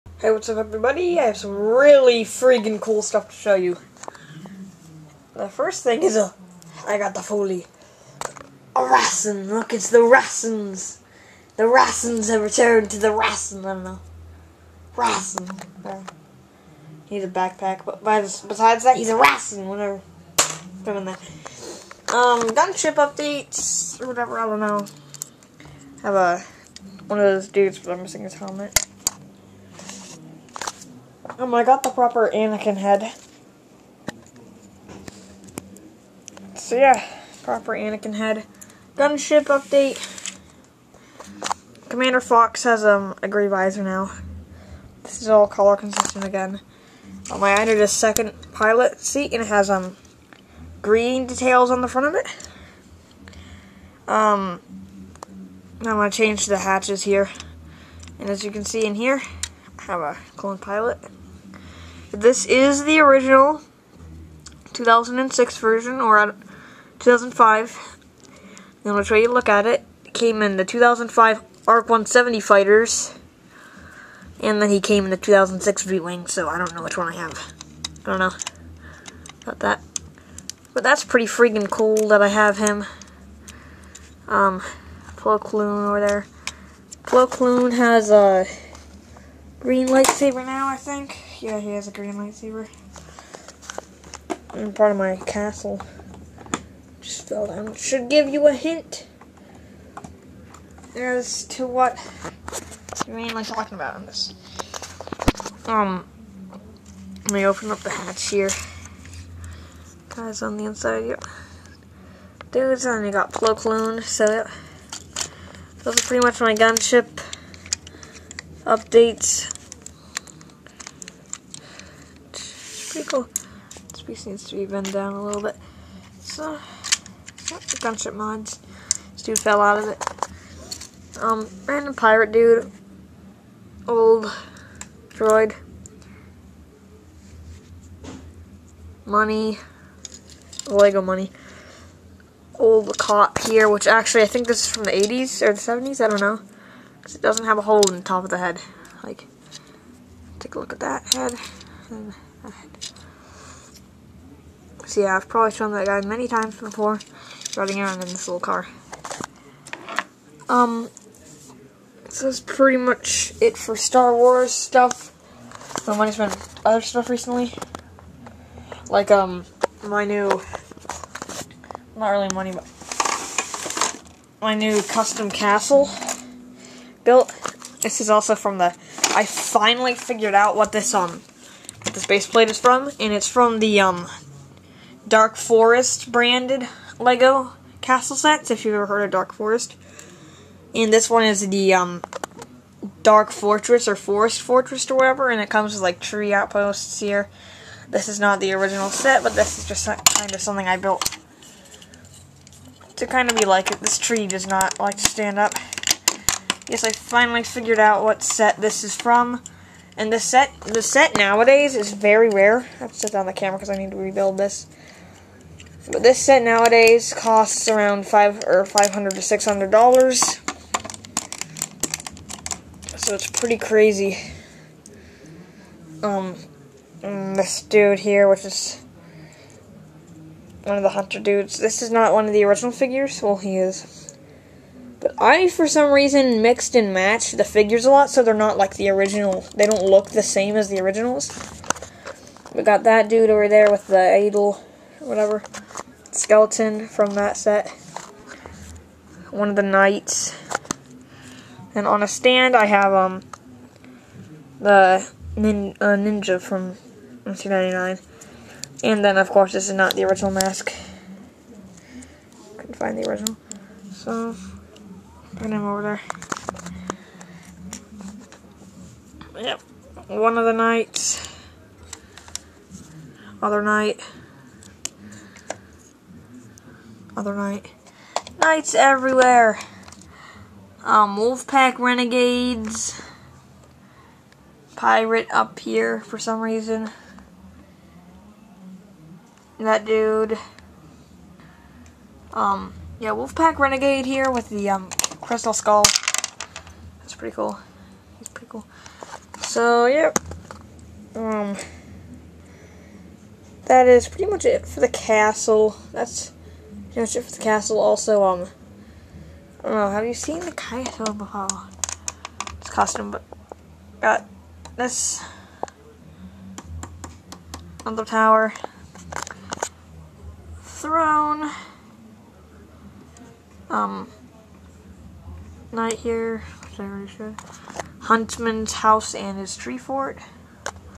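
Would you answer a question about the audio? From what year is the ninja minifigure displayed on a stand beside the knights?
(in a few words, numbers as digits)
1999.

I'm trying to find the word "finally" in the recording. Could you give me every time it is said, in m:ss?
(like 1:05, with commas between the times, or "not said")
2:59, 3:26.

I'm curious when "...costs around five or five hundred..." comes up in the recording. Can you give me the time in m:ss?
3:37.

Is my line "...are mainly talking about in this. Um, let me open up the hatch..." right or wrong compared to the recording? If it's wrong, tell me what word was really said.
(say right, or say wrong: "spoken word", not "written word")
right.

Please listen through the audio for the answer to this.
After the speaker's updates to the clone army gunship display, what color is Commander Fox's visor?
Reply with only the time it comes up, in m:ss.
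0:43.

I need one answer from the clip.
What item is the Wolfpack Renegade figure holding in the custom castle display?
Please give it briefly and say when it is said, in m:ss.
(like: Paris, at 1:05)
crystal skull, at 4:55.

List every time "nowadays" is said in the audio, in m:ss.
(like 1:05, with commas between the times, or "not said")
3:31, 3:36.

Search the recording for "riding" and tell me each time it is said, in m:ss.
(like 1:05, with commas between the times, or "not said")
2:37.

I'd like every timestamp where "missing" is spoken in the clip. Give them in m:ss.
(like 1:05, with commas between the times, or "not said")
0:28.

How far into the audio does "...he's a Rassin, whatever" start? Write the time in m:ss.
0:18.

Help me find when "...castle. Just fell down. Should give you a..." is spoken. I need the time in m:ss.
1:35.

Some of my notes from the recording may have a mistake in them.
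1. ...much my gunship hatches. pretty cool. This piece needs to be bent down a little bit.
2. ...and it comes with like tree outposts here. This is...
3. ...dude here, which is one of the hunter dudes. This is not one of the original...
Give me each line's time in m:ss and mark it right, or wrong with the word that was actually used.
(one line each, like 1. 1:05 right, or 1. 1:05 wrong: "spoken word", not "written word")
1. 1:56 wrong: "updates", not "hatches"
2. 3:15 right
3. 3:47 right.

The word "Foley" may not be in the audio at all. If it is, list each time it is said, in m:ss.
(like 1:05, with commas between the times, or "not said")
0:07.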